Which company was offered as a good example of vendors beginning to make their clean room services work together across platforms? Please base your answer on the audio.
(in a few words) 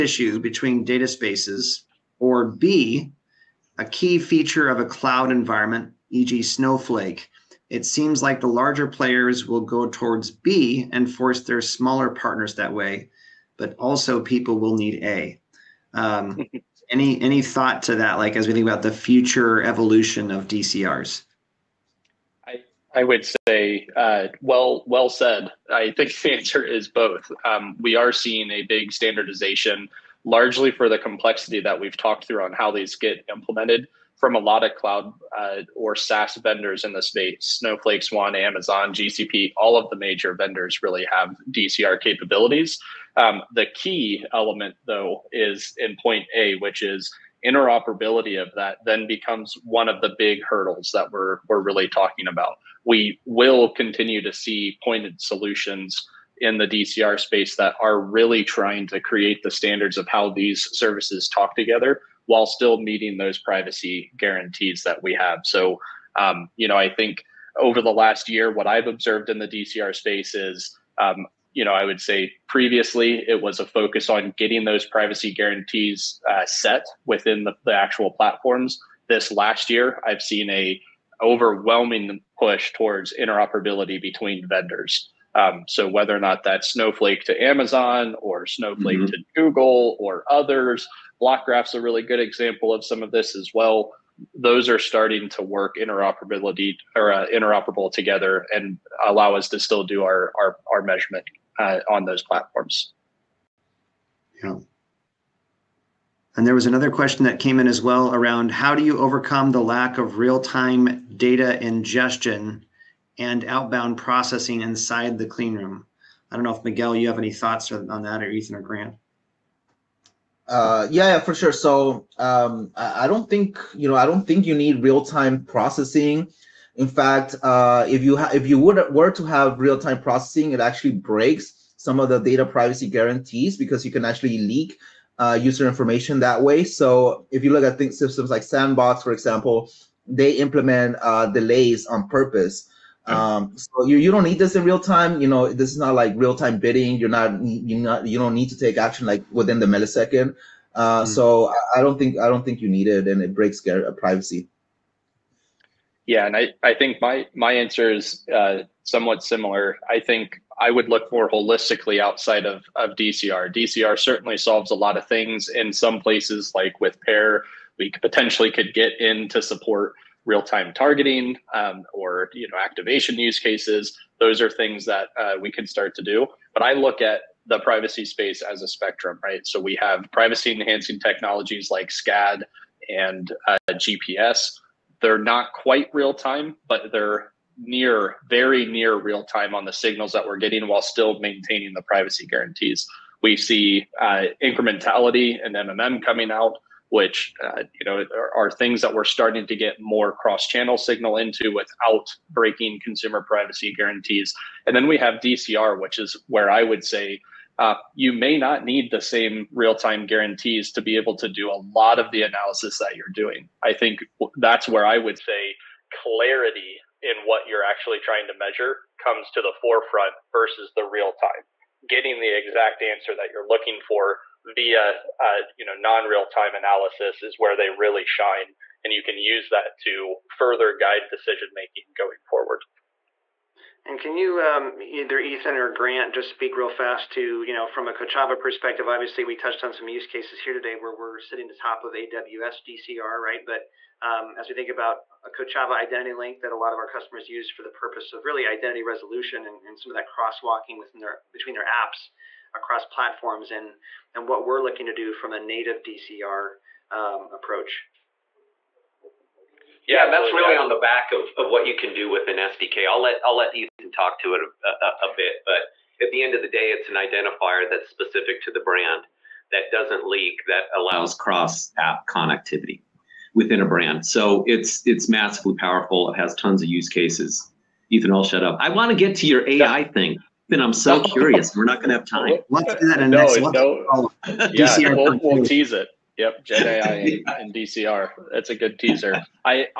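BlockGraph.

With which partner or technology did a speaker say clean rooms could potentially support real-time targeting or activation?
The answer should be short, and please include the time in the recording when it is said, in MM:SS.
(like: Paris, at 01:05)
Pair, at 02:47.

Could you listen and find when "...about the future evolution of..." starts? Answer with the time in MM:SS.
00:18.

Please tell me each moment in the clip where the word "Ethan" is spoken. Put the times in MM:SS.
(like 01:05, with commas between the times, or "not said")
01:58, 03:55, 04:23, 04:37.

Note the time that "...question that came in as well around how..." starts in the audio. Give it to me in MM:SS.
01:46.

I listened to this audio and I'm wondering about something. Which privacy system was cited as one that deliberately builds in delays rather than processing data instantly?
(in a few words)
Sandbox.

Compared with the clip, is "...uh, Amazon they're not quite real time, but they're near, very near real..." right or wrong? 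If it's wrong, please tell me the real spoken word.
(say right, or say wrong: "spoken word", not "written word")
wrong: "GPS", not "Amazon".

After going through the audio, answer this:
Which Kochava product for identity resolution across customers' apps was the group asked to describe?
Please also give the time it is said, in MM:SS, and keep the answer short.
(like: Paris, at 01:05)
Kochava identity link, at 04:05.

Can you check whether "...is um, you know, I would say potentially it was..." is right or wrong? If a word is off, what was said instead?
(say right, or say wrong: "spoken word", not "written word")
wrong: "previously", not "potentially".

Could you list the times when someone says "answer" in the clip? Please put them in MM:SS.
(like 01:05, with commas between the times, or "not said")
00:26, 02:37, 03:42.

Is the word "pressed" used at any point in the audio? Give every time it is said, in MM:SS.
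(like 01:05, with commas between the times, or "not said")
not said.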